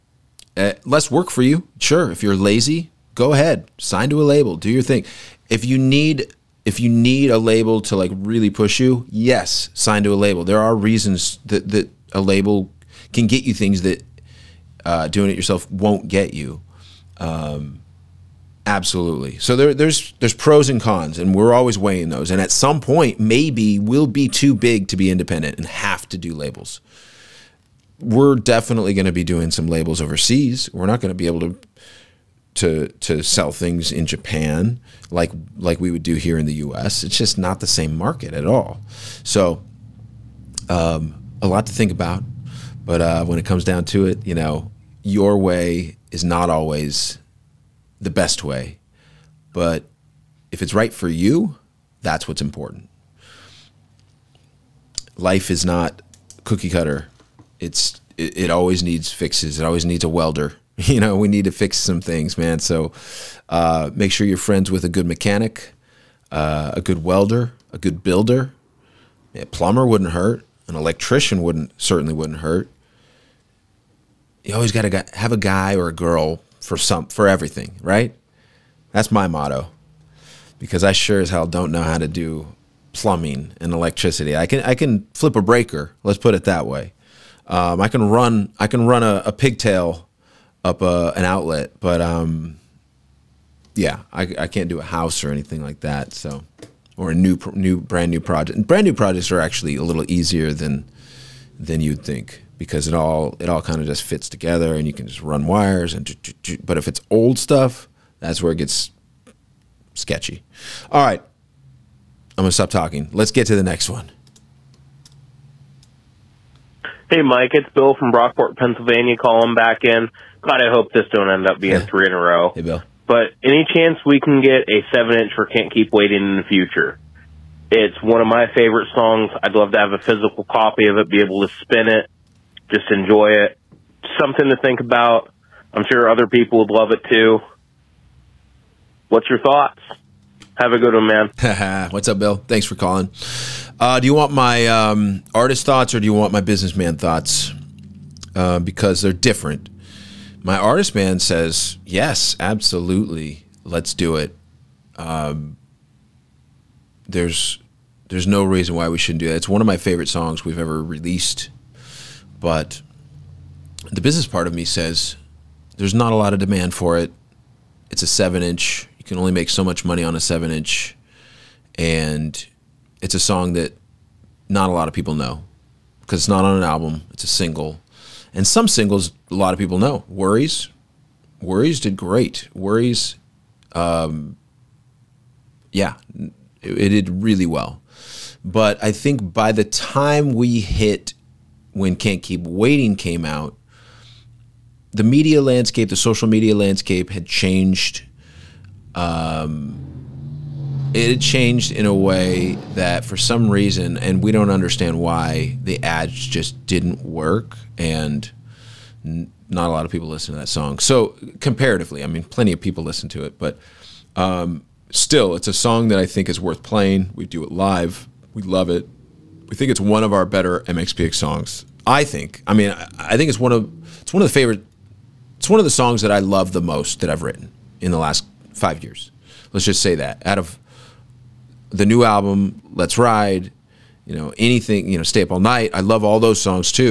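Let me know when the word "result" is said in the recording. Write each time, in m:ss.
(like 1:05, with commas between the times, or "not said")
not said.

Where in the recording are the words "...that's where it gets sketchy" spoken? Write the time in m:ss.
1:48.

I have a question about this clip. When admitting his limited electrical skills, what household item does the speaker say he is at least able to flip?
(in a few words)
A breaker.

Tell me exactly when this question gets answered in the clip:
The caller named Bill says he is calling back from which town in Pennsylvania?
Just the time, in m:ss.
1:58.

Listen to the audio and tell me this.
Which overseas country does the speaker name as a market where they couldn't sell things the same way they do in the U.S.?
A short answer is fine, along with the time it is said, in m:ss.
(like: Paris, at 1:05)
Japan, at 0:34.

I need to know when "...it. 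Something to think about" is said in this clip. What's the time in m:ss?
2:13.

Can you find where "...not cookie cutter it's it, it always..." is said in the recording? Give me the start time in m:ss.
0:55.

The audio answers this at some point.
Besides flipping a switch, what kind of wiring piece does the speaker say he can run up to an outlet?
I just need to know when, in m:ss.
1:29.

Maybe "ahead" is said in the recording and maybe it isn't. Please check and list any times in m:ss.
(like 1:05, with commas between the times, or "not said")
0:03.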